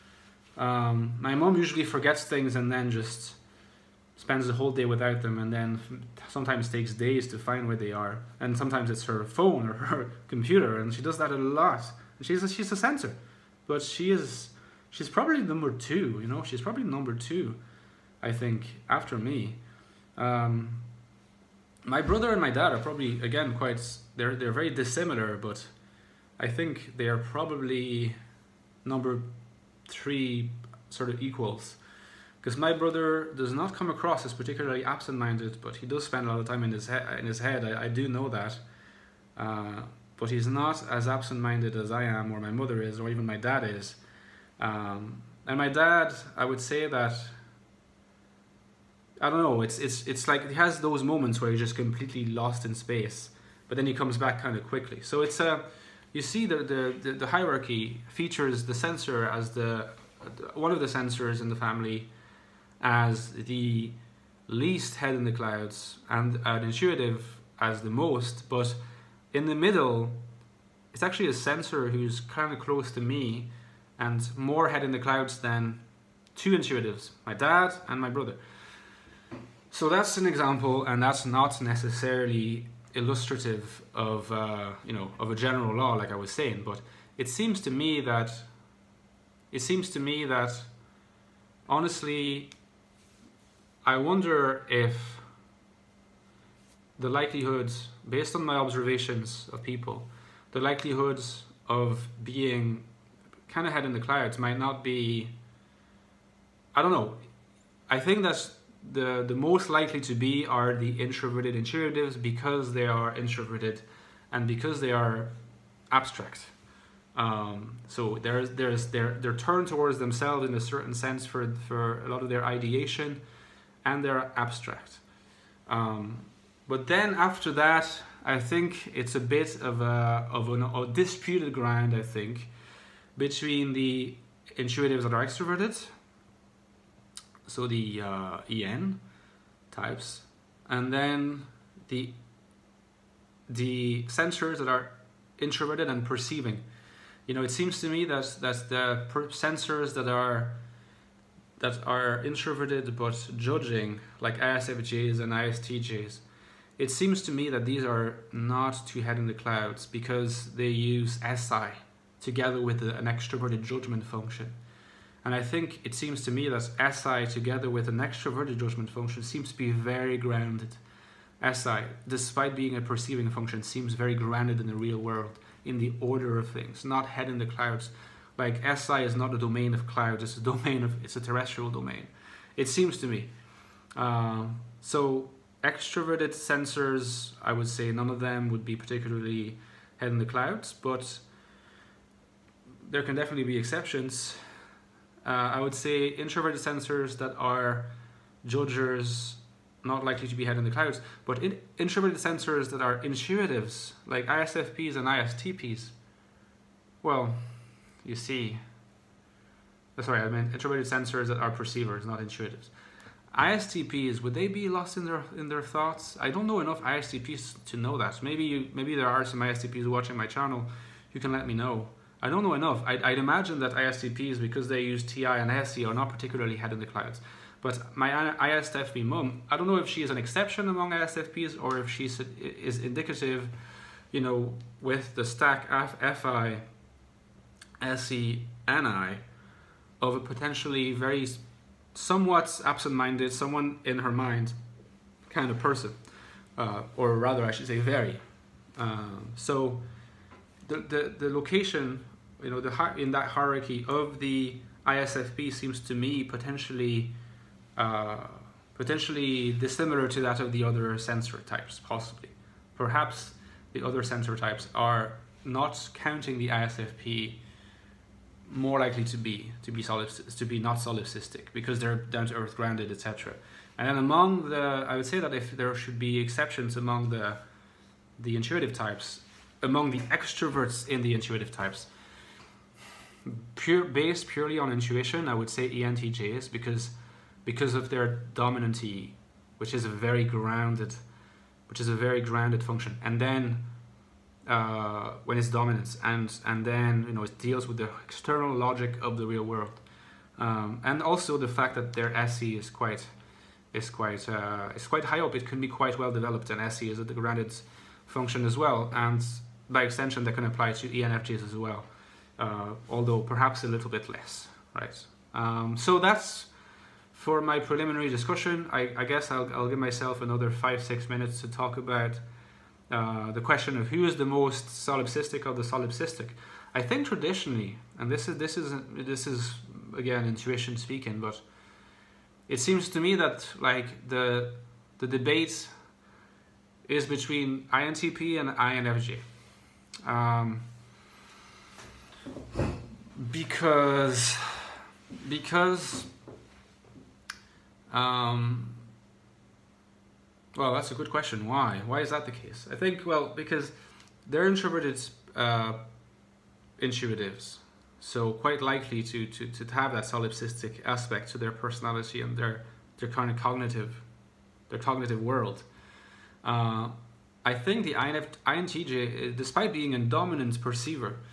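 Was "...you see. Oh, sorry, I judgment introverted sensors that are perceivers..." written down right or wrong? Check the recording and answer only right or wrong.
wrong.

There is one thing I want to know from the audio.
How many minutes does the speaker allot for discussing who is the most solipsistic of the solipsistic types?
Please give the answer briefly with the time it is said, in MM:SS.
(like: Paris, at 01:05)
5 or 6 minutes, at 05:20.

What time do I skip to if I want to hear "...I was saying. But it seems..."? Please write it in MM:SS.
01:26.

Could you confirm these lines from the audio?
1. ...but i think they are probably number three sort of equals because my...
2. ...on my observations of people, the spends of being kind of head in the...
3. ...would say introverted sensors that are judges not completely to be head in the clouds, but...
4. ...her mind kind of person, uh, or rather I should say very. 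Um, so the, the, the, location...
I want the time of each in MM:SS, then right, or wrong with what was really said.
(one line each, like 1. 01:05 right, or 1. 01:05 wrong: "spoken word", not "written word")
1. 00:25 right
2. 01:38 wrong: "likelihoods", not "spends"
3. 03:15 wrong: "likely", not "completely"
4. 04:03 right.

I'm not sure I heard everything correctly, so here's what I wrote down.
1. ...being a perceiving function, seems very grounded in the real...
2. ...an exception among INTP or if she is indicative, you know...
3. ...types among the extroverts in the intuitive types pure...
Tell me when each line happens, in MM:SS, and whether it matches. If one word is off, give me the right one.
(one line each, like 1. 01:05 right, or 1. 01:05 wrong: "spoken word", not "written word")
1. 02:52 right
2. 03:50 wrong: "ISFPs", not "INTP"
3. 04:38 right.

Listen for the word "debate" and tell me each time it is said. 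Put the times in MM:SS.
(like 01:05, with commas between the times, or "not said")
05:35.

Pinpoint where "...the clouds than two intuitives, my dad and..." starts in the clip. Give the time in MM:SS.
01:14.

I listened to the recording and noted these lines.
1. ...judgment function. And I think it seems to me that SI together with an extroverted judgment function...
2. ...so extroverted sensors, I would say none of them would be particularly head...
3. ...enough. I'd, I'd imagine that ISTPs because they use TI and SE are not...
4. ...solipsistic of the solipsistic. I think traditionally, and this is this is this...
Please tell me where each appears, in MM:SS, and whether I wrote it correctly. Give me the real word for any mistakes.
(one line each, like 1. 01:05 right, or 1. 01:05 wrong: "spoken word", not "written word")
1. 02:43 right
2. 03:04 right
3. 03:42 right
4. 05:24 right.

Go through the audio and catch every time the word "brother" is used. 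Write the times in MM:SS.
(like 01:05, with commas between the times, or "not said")
00:22, 00:32, 01:18.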